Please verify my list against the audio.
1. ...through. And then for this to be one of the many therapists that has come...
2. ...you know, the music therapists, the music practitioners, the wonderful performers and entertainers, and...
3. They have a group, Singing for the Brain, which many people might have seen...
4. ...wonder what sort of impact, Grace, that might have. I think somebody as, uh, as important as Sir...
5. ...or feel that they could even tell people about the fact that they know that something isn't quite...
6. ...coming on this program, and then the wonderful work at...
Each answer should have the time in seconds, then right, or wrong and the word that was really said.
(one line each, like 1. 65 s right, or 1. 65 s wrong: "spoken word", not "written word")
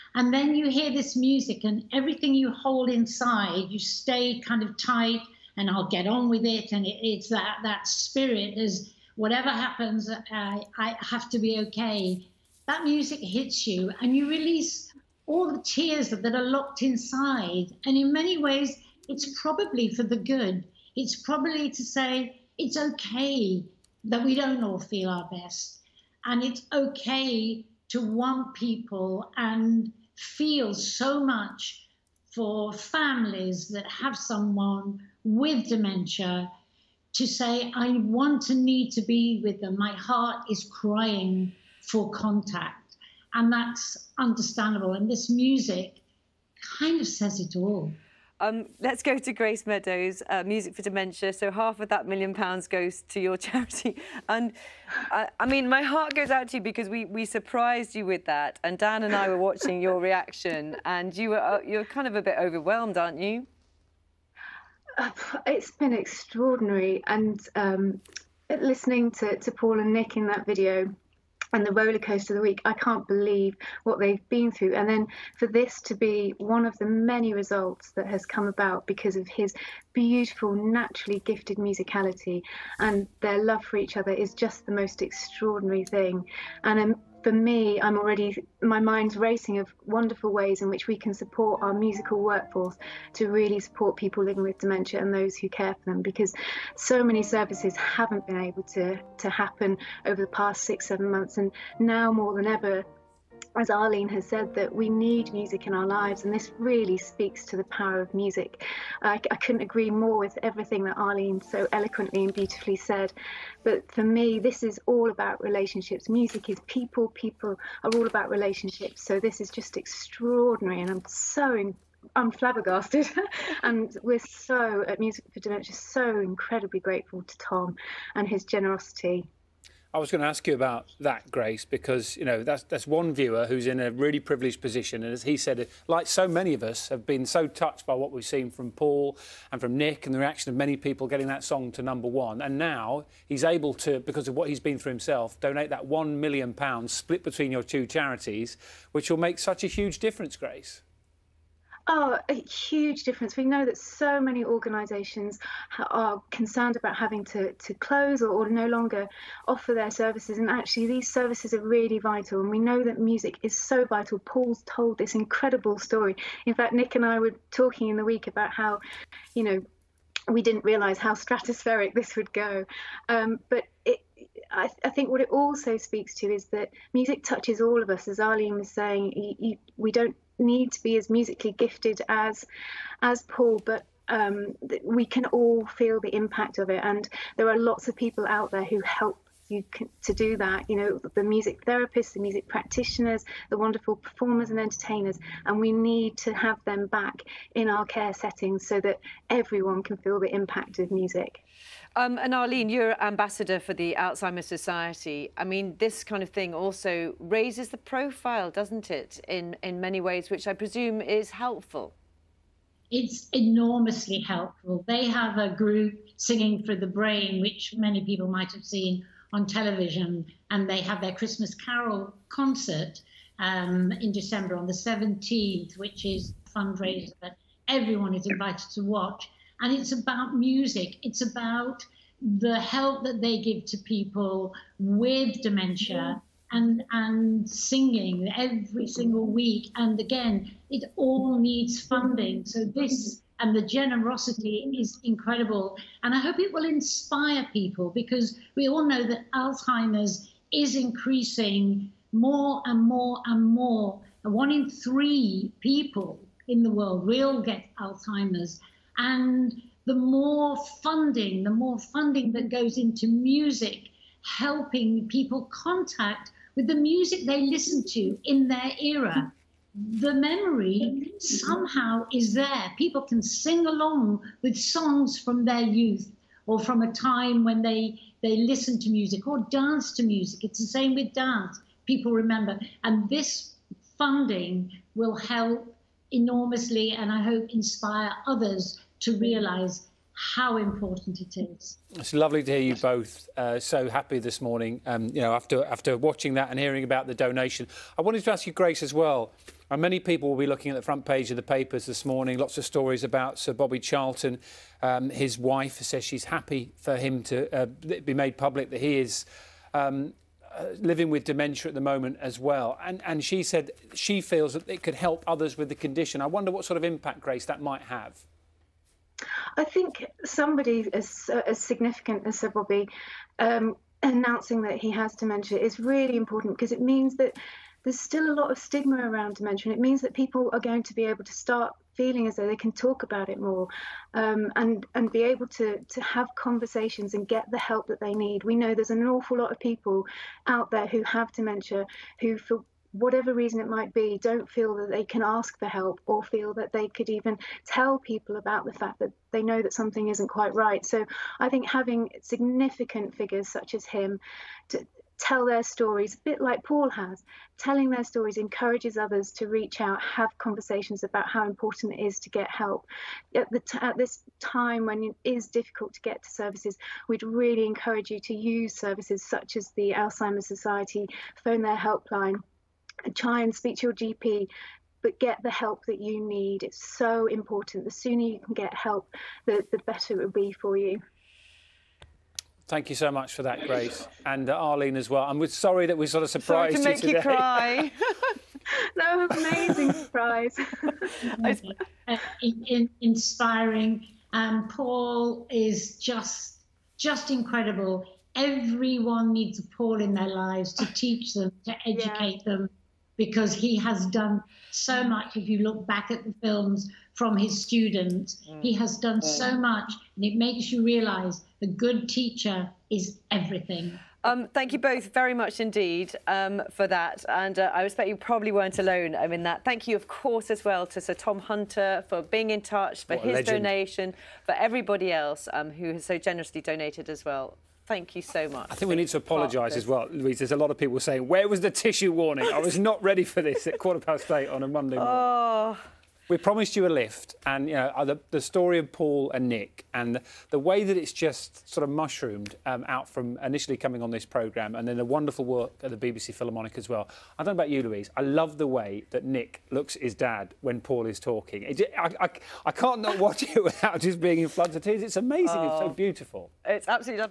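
1. 74 s wrong: "results", not "therapists"
2. 190 s right
3. 214 s right
4. 316 s wrong: "significant", not "important"
5. 346 s right
6. 443 s right.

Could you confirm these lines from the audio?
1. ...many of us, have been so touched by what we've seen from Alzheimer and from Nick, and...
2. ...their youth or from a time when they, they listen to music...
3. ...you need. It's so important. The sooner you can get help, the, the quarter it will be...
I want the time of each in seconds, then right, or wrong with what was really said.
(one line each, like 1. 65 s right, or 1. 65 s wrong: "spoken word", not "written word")
1. 136 s wrong: "Paul", not "Alzheimer"
2. 275 s right
3. 375 s wrong: "better", not "quarter".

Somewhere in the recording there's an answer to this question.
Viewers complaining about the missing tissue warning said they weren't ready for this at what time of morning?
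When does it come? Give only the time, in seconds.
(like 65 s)
433 s.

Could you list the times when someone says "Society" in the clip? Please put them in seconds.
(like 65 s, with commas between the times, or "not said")
204 s, 370 s.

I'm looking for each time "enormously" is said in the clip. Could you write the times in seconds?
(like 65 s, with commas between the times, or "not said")
213 s, 286 s.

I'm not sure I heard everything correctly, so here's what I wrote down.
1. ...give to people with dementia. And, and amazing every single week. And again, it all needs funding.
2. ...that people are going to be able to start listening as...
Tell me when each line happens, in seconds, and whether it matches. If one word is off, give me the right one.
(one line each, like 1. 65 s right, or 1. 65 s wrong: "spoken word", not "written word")
1. 233 s wrong: "singing", not "amazing"
2. 330 s wrong: "feeling", not "listening".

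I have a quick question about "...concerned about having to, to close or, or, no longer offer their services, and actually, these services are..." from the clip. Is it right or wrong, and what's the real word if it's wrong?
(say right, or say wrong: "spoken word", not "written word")
right.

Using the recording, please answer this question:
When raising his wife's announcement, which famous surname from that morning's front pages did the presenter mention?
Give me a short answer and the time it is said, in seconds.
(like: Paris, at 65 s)
Charlton, at 303 s.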